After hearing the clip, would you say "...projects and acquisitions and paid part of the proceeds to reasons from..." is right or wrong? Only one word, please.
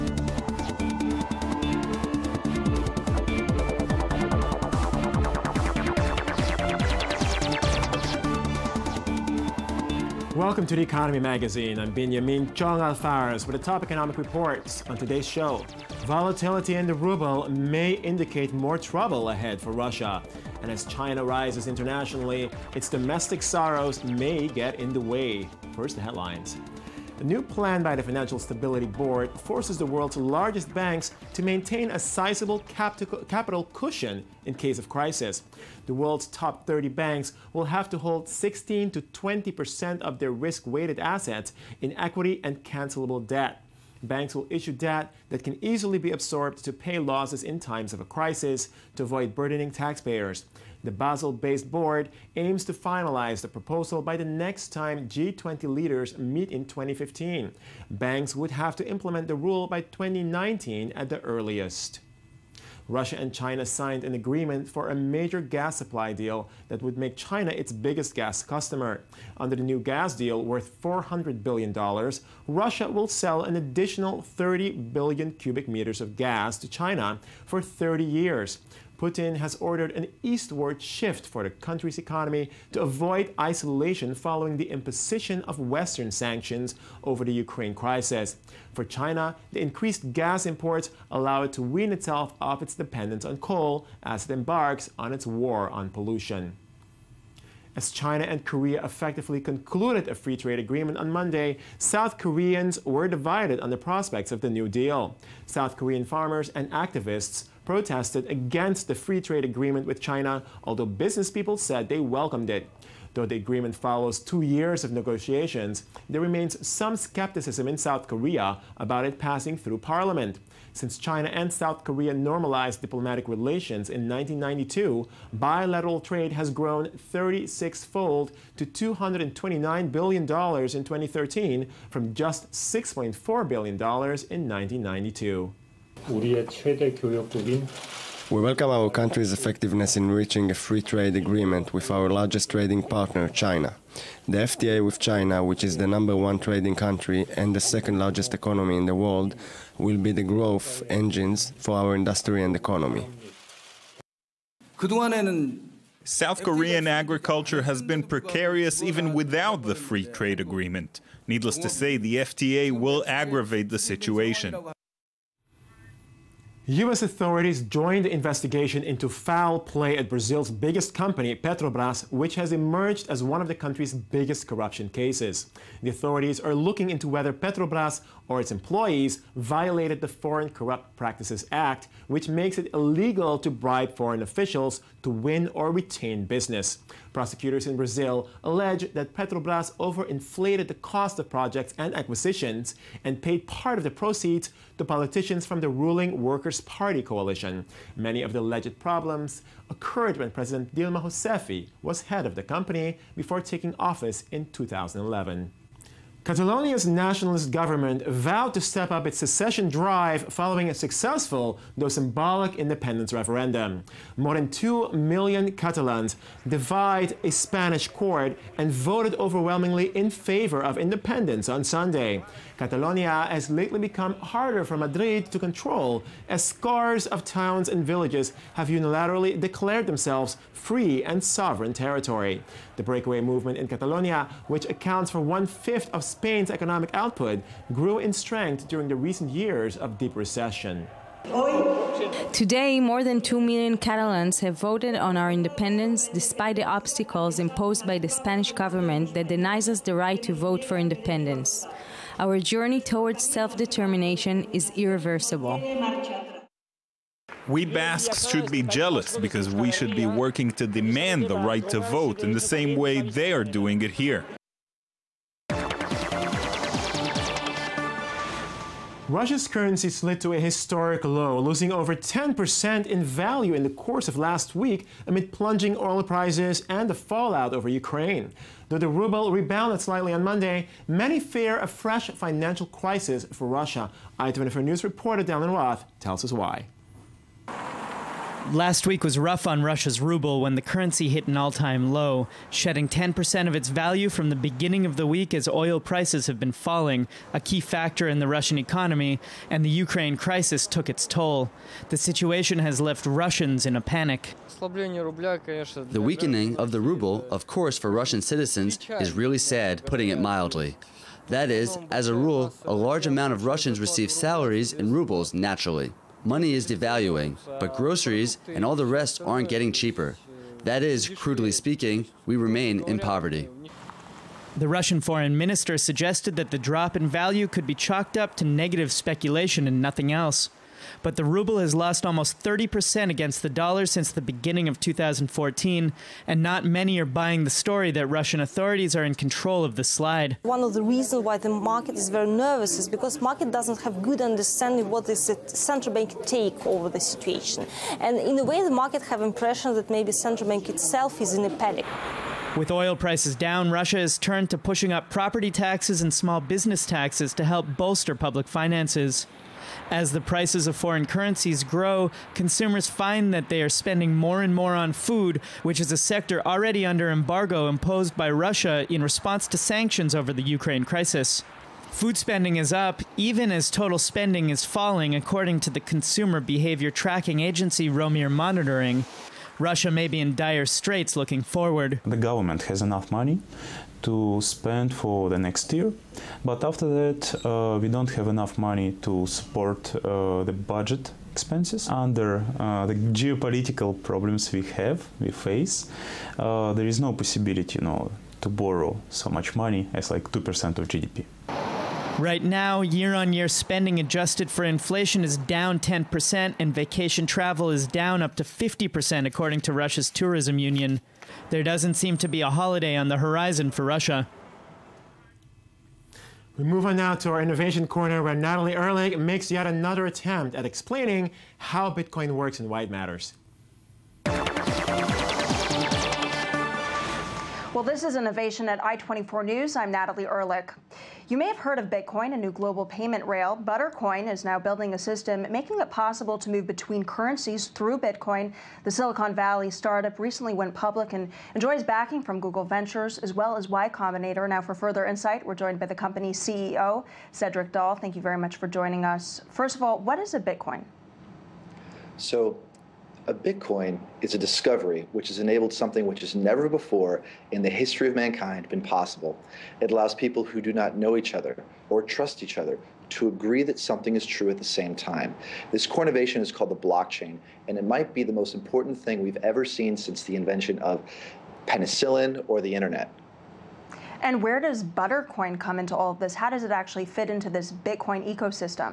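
wrong.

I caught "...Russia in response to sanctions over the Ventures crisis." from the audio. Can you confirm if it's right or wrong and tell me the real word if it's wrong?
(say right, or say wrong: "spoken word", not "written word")
wrong: "Ukraine", not "Ventures".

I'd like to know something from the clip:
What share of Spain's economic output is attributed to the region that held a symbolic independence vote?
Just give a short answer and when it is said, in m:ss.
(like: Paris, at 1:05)
one fifth, at 3:55.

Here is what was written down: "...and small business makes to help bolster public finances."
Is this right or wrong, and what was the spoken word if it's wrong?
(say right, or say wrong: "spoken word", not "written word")
wrong: "taxes", not "makes".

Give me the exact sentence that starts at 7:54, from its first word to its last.
And where does Buttercoin come into all of this?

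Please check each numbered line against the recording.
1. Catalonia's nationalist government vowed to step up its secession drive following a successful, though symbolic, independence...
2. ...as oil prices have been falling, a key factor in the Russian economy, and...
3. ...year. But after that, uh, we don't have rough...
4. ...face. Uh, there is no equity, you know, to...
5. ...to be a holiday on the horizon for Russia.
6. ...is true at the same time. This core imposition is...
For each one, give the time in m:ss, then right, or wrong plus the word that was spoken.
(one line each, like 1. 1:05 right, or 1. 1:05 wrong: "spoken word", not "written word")
1. 3:26 right
2. 4:55 right
3. 6:25 wrong: "enough", not "rough"
4. 6:35 wrong: "possibility", not "equity"
5. 6:52 right
6. 7:44 wrong: "innovation", not "imposition".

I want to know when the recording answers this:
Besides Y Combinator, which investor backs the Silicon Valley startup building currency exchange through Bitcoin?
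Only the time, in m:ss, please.
7:22.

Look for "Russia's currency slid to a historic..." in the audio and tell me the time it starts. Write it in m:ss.
4:29.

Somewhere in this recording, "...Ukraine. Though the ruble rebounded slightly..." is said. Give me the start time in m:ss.
4:37.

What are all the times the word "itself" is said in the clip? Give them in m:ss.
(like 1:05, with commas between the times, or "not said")
1:31, 5:50.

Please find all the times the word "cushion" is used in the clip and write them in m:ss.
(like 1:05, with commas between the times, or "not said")
0:33.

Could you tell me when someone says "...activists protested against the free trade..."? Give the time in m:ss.
1:46.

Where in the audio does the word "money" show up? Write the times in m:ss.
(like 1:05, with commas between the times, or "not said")
5:16, 6:23, 6:28, 6:39.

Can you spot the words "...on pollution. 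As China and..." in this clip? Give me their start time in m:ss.
1:35.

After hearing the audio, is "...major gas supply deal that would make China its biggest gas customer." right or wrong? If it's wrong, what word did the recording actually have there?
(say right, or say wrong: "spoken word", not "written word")
right.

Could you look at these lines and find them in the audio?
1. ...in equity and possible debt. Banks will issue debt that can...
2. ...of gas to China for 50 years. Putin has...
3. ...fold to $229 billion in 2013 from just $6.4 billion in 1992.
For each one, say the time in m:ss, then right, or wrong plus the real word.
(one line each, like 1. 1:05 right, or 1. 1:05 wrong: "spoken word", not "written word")
1. 0:41 wrong: "cancelable", not "possible"
2. 1:16 wrong: "30", not "50"
3. 2:07 right.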